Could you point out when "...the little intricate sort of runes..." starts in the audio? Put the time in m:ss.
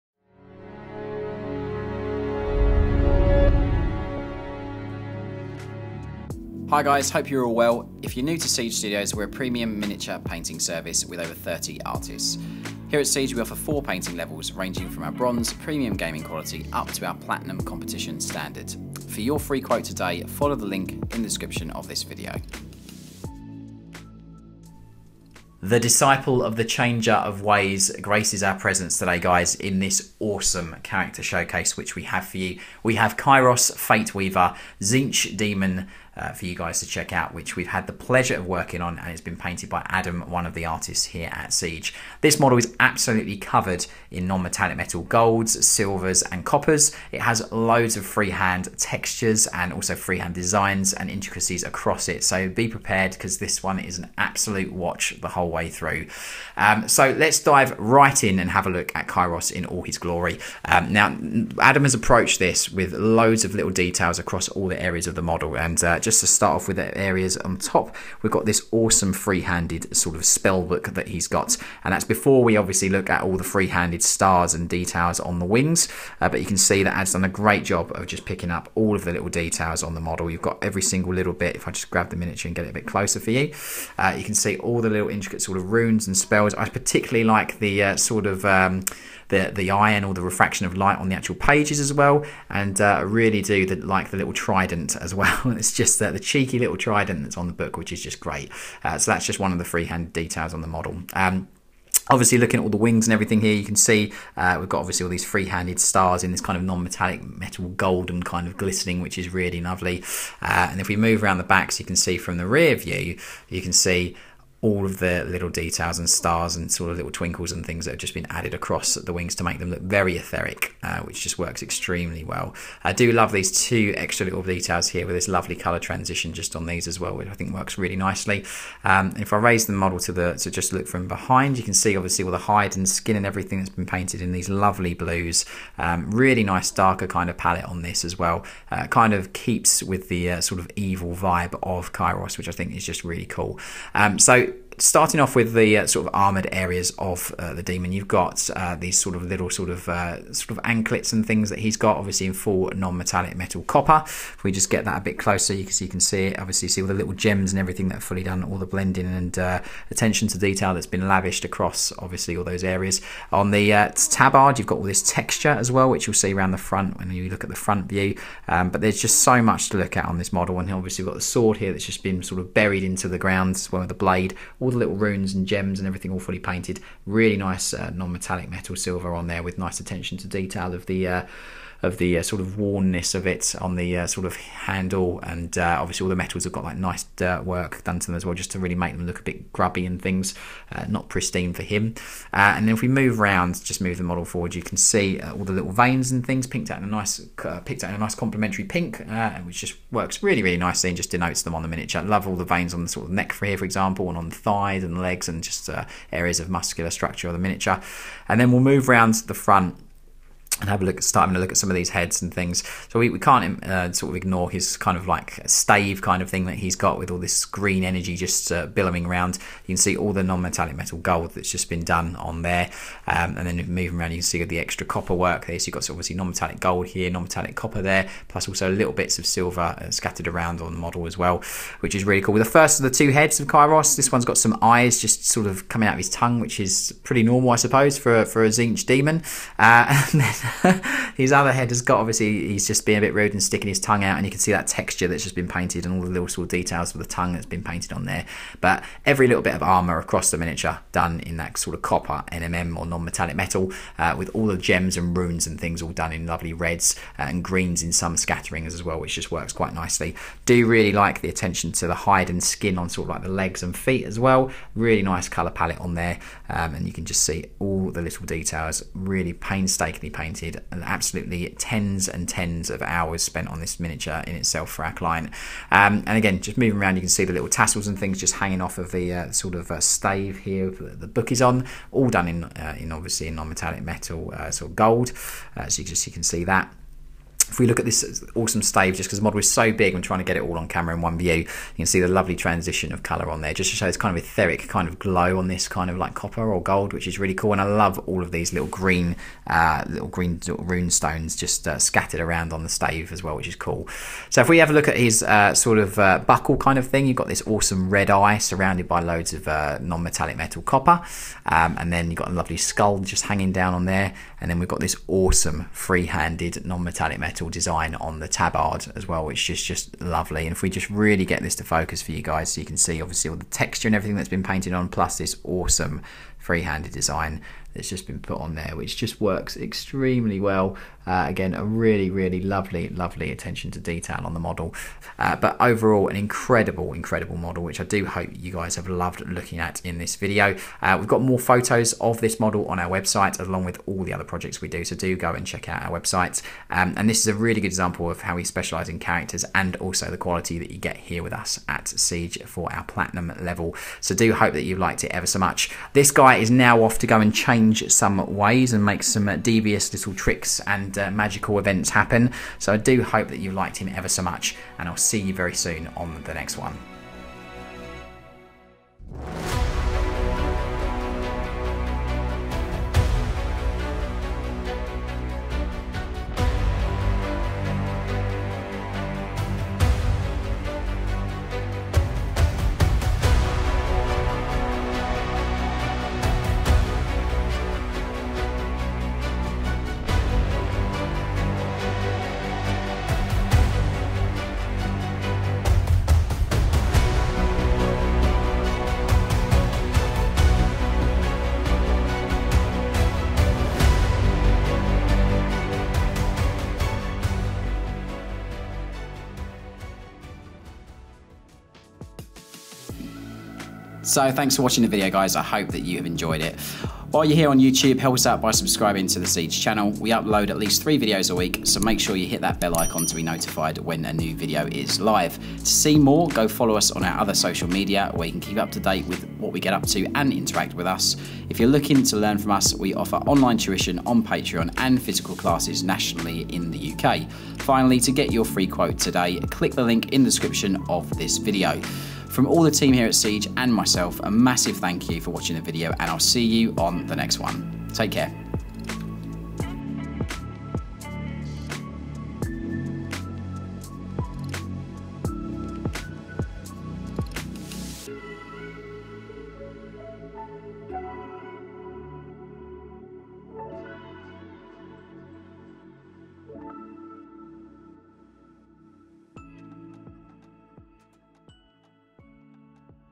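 1:24.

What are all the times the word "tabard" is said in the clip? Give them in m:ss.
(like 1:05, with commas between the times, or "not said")
2:44, 5:18.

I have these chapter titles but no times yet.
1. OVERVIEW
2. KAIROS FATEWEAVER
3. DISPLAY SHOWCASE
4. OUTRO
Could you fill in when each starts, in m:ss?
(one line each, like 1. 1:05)
1. 0:25
2. 1:00
3. 6:08
4. 6:53.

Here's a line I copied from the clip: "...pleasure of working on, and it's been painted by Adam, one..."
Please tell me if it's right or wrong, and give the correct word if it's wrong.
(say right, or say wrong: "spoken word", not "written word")
right.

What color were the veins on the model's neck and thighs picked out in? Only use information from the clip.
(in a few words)
pink.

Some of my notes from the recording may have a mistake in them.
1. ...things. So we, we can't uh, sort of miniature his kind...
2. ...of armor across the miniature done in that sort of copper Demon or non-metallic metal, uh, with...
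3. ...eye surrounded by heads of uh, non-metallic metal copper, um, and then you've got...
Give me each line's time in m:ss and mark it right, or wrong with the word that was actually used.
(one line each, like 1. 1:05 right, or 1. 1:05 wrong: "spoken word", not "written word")
1. 3:32 wrong: "ignore", not "miniature"
2. 4:09 wrong: "NMM", not "Demon"
3. 5:08 wrong: "loads", not "heads".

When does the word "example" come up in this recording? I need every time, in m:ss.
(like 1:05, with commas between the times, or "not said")
3:23, 5:47.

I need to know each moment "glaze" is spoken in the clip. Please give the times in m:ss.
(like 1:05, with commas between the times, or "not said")
not said.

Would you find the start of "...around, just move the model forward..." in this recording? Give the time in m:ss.
3:13.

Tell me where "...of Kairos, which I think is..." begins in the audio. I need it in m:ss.
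2:21.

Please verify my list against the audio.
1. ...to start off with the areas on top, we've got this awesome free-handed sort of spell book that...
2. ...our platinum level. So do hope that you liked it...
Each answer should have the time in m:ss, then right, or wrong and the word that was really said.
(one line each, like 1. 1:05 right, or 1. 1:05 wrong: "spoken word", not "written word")
1. 1:06 right
2. 5:52 right.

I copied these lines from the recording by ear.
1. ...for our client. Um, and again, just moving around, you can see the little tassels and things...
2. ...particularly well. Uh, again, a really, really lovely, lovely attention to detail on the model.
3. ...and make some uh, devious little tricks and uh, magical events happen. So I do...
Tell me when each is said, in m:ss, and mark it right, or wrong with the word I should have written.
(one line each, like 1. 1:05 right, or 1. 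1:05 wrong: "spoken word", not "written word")
1. 4:34 right
2. 5:29 wrong: "extremely", not "particularly"
3. 5:58 right.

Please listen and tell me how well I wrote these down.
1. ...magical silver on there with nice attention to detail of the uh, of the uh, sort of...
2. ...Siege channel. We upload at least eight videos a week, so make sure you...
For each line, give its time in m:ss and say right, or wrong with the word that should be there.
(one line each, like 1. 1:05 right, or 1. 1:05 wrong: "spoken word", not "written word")
1. 2:58 wrong: "metal", not "magical"
2. 6:59 wrong: "three", not "eight".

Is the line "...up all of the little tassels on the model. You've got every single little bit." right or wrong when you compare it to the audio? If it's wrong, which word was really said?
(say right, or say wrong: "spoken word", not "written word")
wrong: "details", not "tassels".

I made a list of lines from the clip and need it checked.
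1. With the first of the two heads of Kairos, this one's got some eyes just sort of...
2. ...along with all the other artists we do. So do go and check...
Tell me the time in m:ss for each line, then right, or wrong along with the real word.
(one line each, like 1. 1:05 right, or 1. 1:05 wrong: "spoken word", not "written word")
1. 3:52 right
2. 5:43 wrong: "projects", not "artists".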